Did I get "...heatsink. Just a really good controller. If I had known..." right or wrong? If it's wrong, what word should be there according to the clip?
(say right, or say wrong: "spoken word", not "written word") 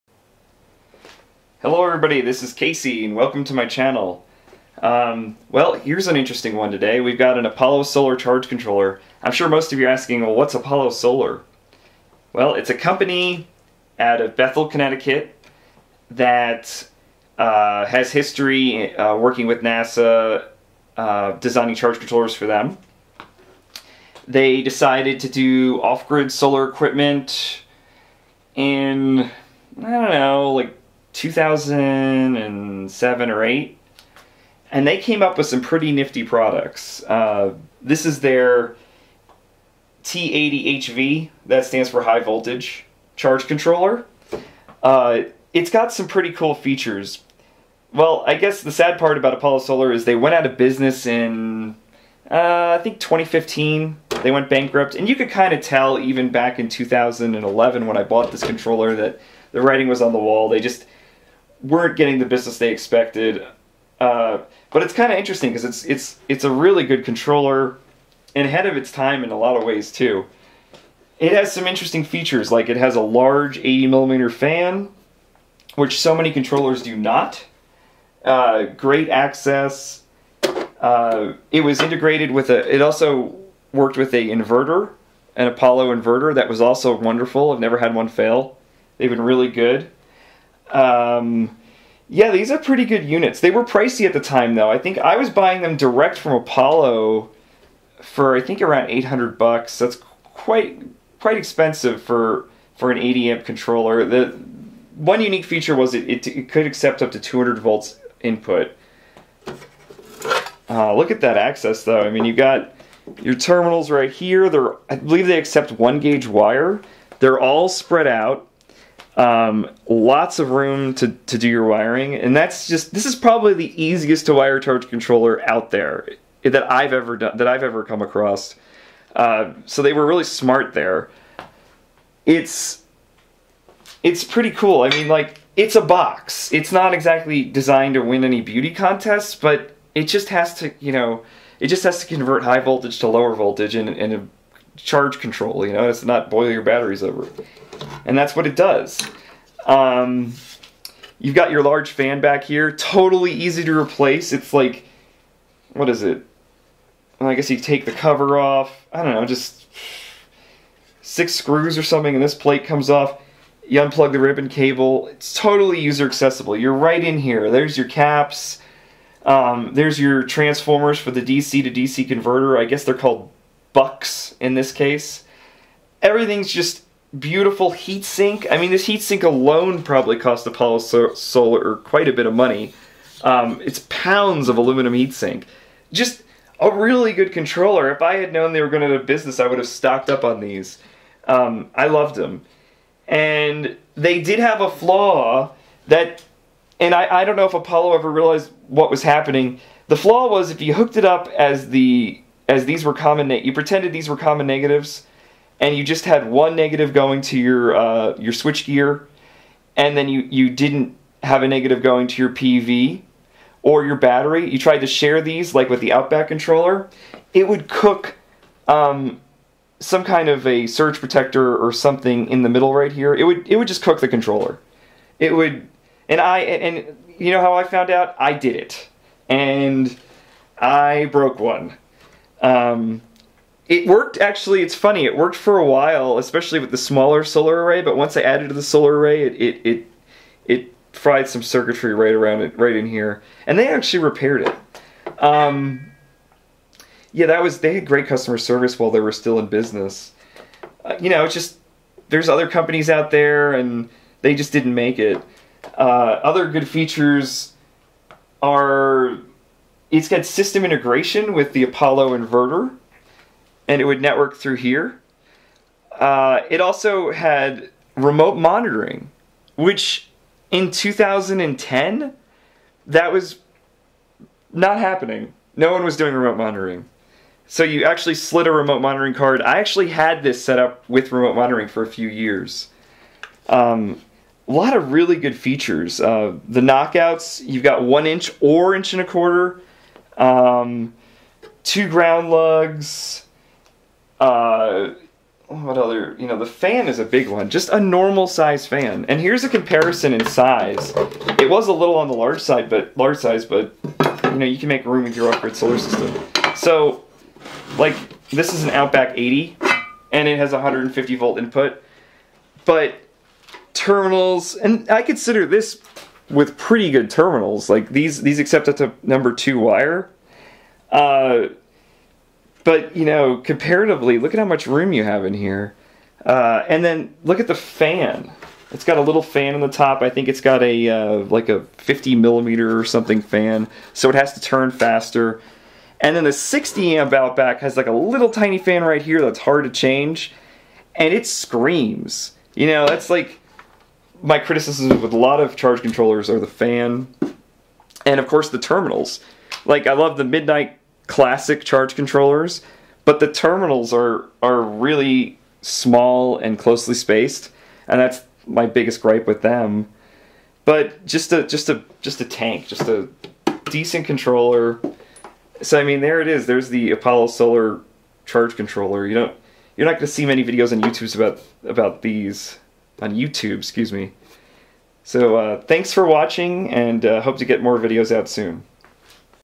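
right.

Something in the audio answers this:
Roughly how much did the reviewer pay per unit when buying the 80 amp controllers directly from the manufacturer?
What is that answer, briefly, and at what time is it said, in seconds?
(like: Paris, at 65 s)
$800, at 98 s.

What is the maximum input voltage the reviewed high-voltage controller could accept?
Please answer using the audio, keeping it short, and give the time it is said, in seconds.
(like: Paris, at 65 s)
200 volts, at 107 s.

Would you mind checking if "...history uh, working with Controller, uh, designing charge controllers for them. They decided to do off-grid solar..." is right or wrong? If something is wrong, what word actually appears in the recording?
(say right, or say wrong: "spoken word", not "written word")
wrong: "NASA", not "Controller".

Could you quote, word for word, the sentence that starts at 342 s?
You know, that's like my criticisms with a lot of charge controllers are the fan and of course the terminals.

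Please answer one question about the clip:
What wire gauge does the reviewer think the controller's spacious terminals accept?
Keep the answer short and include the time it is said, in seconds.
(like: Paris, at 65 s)
1 gauge, at 115 s.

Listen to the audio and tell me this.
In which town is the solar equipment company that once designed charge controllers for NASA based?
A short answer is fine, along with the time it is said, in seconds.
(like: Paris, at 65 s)
Bethel, Connecticut, at 14 s.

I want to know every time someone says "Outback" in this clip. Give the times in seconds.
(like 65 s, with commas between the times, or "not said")
215 s, 308 s, 337 s.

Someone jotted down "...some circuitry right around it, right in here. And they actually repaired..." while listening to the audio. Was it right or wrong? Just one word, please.
right.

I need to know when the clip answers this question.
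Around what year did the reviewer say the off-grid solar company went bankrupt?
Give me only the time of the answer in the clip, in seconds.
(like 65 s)
53 s.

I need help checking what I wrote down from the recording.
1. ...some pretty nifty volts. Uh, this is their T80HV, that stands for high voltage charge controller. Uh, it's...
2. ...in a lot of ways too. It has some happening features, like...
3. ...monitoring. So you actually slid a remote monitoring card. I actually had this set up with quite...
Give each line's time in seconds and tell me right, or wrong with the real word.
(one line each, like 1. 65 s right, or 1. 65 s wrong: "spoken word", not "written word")
1. 35 s wrong: "products", not "volts"
2. 69 s wrong: "interesting", not "happening"
3. 276 s wrong: "remote", not "quite".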